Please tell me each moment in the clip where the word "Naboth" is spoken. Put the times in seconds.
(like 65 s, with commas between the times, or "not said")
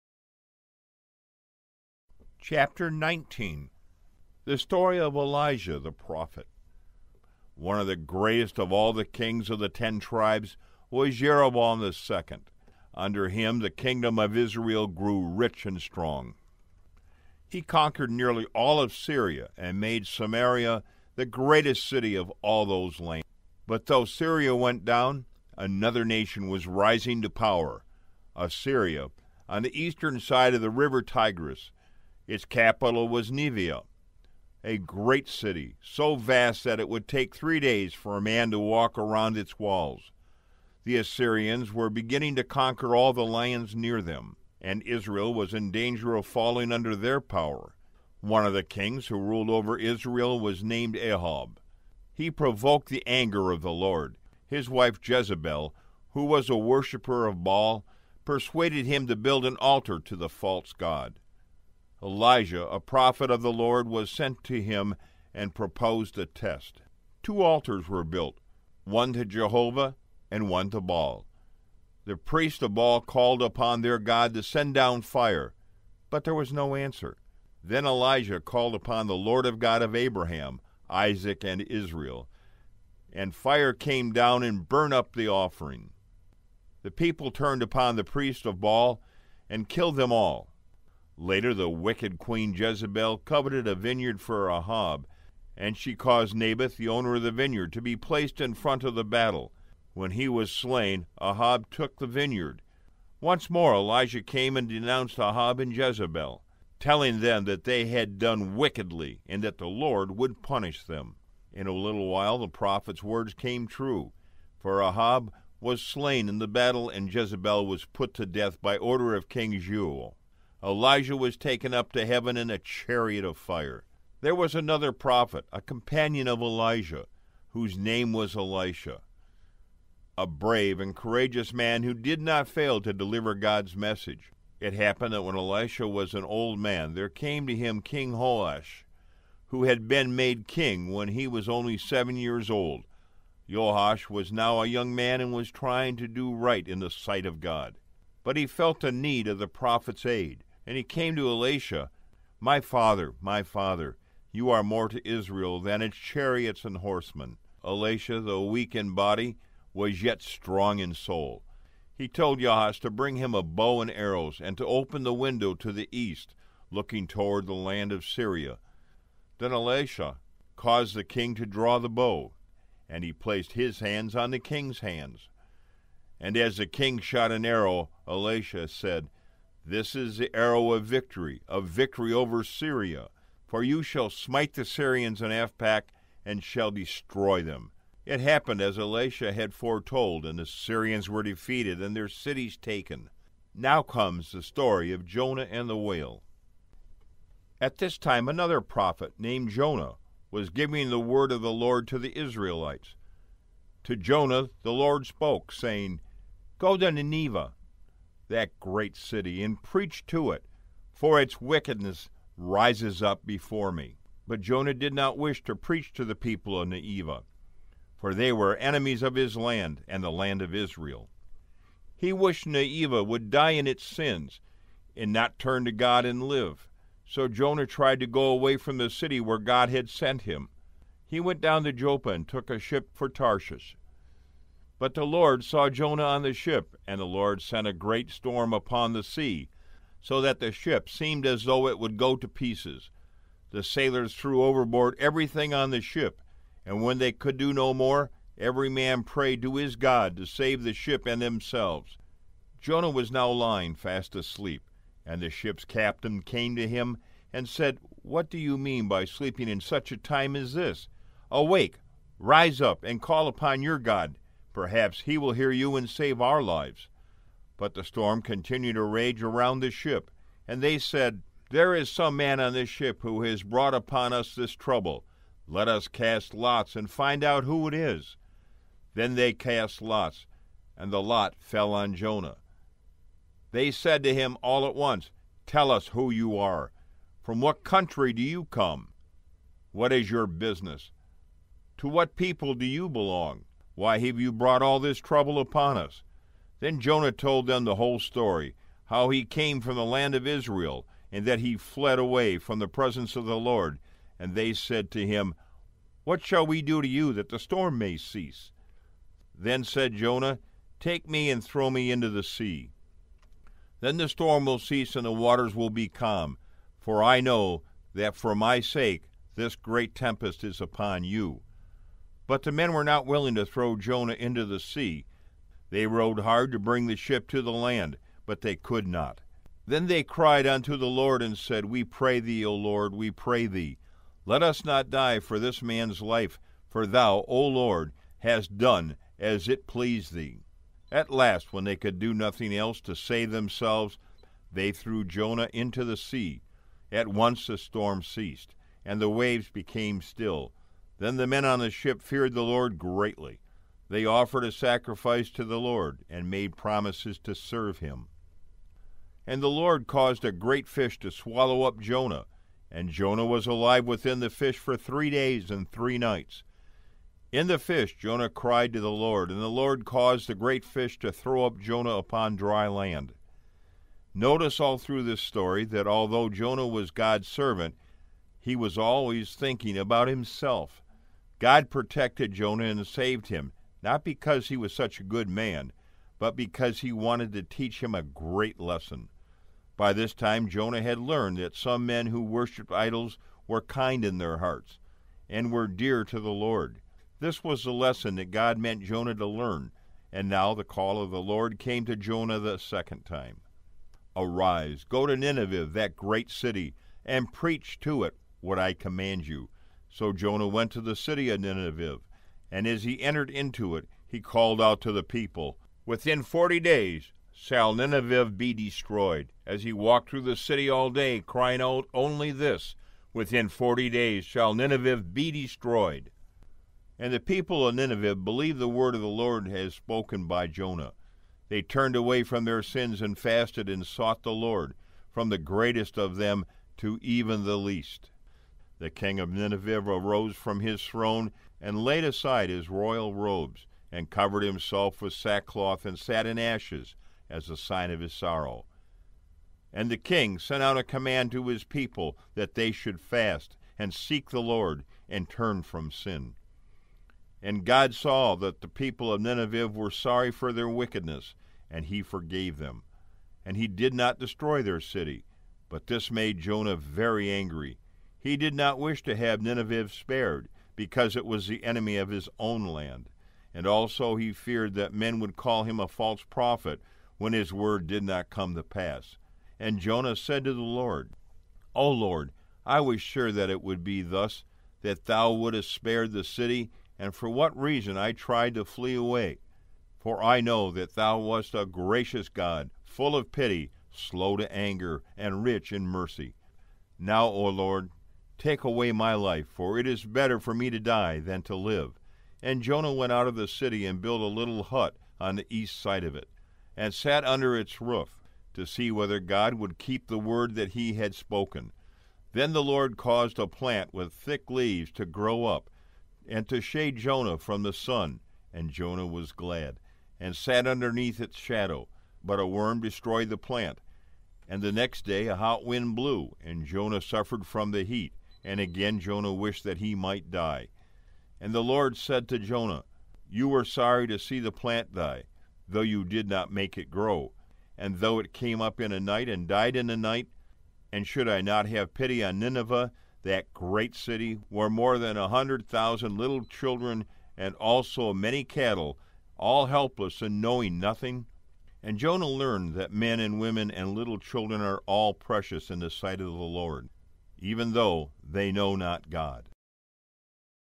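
96 s.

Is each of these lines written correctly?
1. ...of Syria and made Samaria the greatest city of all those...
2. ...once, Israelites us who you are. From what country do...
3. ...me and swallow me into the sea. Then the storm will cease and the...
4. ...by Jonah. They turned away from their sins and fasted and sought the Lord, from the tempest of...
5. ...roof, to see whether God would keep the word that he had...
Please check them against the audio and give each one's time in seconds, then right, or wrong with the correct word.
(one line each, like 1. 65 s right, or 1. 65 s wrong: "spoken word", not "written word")
1. 18 s right
2. 284 s wrong: "Tell", not "Israelites"
3. 311 s wrong: "throw", not "swallow"
4. 430 s wrong: "greatest", not "tempest"
5. 507 s right.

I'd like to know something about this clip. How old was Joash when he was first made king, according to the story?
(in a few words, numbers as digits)
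7.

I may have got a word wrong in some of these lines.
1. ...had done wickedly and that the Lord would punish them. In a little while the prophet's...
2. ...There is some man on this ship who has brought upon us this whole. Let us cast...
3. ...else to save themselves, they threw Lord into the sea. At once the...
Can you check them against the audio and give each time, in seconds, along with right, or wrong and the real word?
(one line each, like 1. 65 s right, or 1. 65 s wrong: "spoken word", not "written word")
1. 107 s right
2. 271 s wrong: "trouble", not "whole"
3. 342 s wrong: "Jonah", not "Lord".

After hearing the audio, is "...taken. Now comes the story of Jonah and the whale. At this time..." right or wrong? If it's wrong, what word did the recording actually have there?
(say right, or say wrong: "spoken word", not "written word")
right.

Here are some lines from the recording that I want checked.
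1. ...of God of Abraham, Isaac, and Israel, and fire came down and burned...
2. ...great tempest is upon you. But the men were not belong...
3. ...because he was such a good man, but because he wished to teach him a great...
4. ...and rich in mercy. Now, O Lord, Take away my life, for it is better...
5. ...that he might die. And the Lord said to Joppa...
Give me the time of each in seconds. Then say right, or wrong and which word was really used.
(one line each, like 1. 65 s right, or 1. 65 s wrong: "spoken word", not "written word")
1. 79 s right
2. 319 s wrong: "willing", not "belong"
3. 384 s wrong: "wanted", not "wished"
4. 495 s right
5. 529 s wrong: "Jonah", not "Joppa".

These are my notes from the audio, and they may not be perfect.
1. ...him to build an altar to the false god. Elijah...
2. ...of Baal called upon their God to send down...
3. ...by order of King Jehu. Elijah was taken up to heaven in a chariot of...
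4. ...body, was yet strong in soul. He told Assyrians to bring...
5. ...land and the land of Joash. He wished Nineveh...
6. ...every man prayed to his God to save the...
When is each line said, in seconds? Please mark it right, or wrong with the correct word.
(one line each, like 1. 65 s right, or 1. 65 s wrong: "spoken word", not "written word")
1. 58 s right
2. 72 s right
3. 118 s right
4. 158 s wrong: "Yahaz", not "Assyrians"
5. 219 s wrong: "Israel", not "Joash"
6. 248 s right.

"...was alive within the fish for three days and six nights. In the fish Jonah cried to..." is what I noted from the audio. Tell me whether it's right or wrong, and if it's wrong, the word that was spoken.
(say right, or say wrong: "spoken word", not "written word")
wrong: "three", not "six".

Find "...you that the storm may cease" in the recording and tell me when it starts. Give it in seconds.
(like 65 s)
306 s.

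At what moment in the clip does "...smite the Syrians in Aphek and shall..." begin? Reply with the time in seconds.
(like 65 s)
184 s.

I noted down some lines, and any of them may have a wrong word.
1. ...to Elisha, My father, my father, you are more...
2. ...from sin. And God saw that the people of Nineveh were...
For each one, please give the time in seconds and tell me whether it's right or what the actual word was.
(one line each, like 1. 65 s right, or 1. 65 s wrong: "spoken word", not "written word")
1. 151 s right
2. 455 s right.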